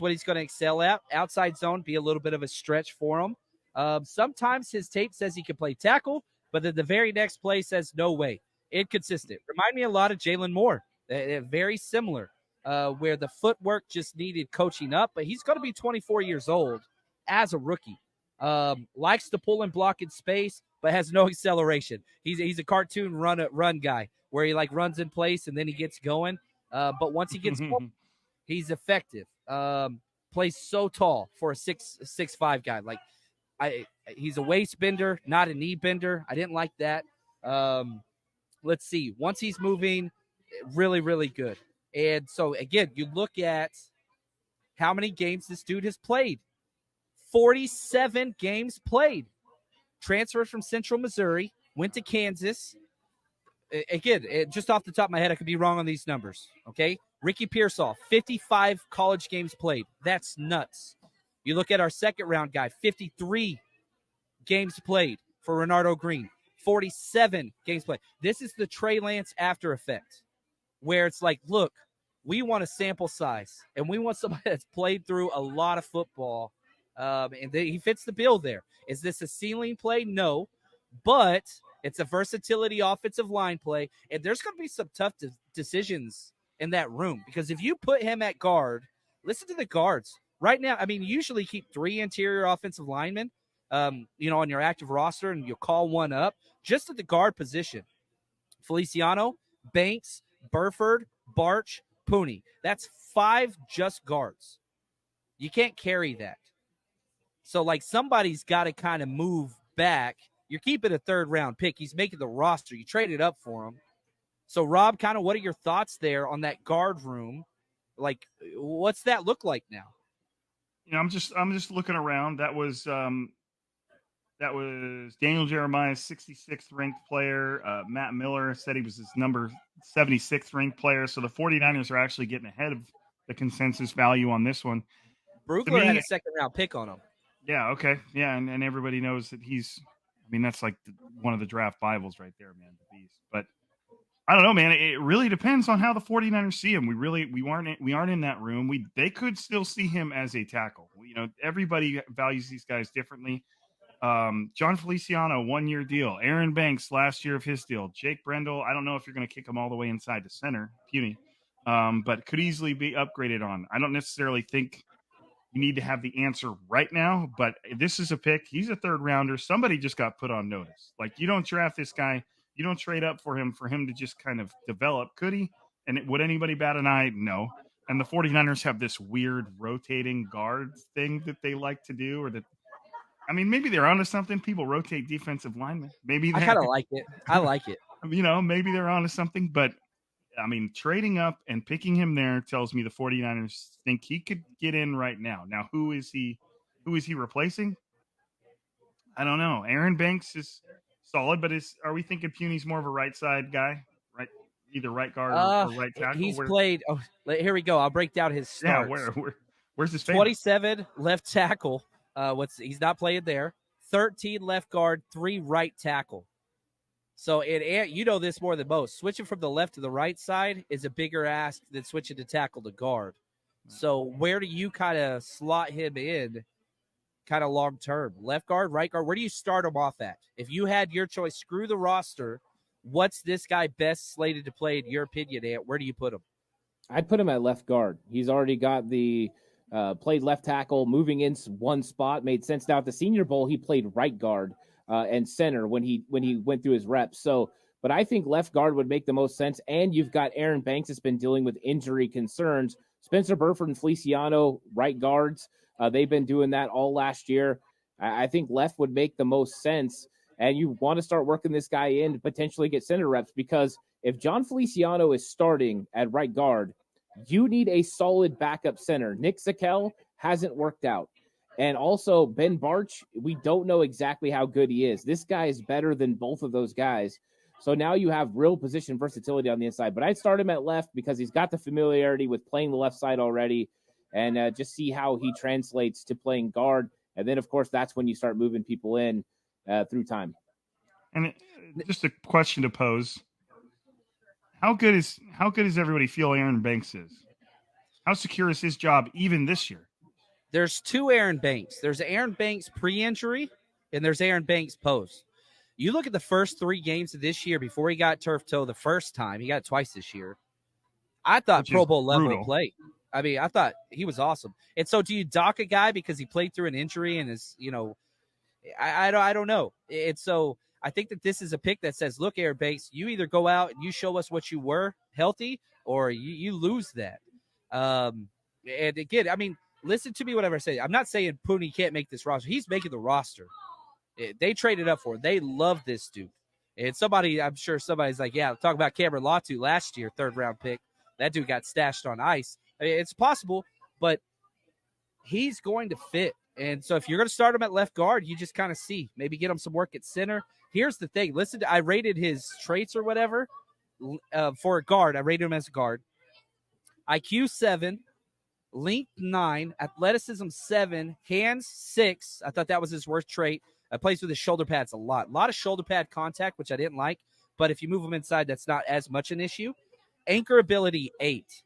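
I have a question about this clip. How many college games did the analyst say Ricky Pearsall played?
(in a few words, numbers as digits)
55.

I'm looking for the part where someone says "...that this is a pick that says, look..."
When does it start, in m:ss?
5:21.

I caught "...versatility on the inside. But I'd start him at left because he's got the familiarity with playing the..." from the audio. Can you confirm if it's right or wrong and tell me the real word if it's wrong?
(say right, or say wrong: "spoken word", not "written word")
right.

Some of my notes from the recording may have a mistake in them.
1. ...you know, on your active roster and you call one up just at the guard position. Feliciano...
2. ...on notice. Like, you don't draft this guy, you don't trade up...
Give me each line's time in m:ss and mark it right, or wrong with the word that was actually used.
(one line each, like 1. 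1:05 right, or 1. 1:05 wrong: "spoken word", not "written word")
1. 1:34 right
2. 2:50 right.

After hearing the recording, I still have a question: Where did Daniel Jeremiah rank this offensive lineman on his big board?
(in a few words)
66th.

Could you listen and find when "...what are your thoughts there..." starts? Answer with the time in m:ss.
1:55.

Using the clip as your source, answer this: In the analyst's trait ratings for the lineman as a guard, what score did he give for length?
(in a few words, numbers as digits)
9.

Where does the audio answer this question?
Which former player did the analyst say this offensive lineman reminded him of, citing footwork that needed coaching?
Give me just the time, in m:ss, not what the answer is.
0:10.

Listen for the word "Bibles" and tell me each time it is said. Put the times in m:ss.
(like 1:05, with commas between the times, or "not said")
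2:21.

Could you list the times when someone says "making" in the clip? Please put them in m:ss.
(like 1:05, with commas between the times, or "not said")
1:51, 5:32.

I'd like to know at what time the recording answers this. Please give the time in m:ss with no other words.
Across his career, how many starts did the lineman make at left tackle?
3:30.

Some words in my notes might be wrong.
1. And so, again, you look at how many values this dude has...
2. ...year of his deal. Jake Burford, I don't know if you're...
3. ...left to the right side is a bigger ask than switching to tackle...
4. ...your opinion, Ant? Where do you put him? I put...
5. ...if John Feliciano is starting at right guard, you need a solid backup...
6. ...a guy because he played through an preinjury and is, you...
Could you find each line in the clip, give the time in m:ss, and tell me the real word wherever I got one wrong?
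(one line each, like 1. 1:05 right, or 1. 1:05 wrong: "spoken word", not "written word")
1. 0:41 wrong: "games", not "values"
2. 2:37 wrong: "Brendel", not "Burford"
3. 3:39 right
4. 3:54 right
5. 4:24 right
6. 5:15 wrong: "injury", not "preinjury".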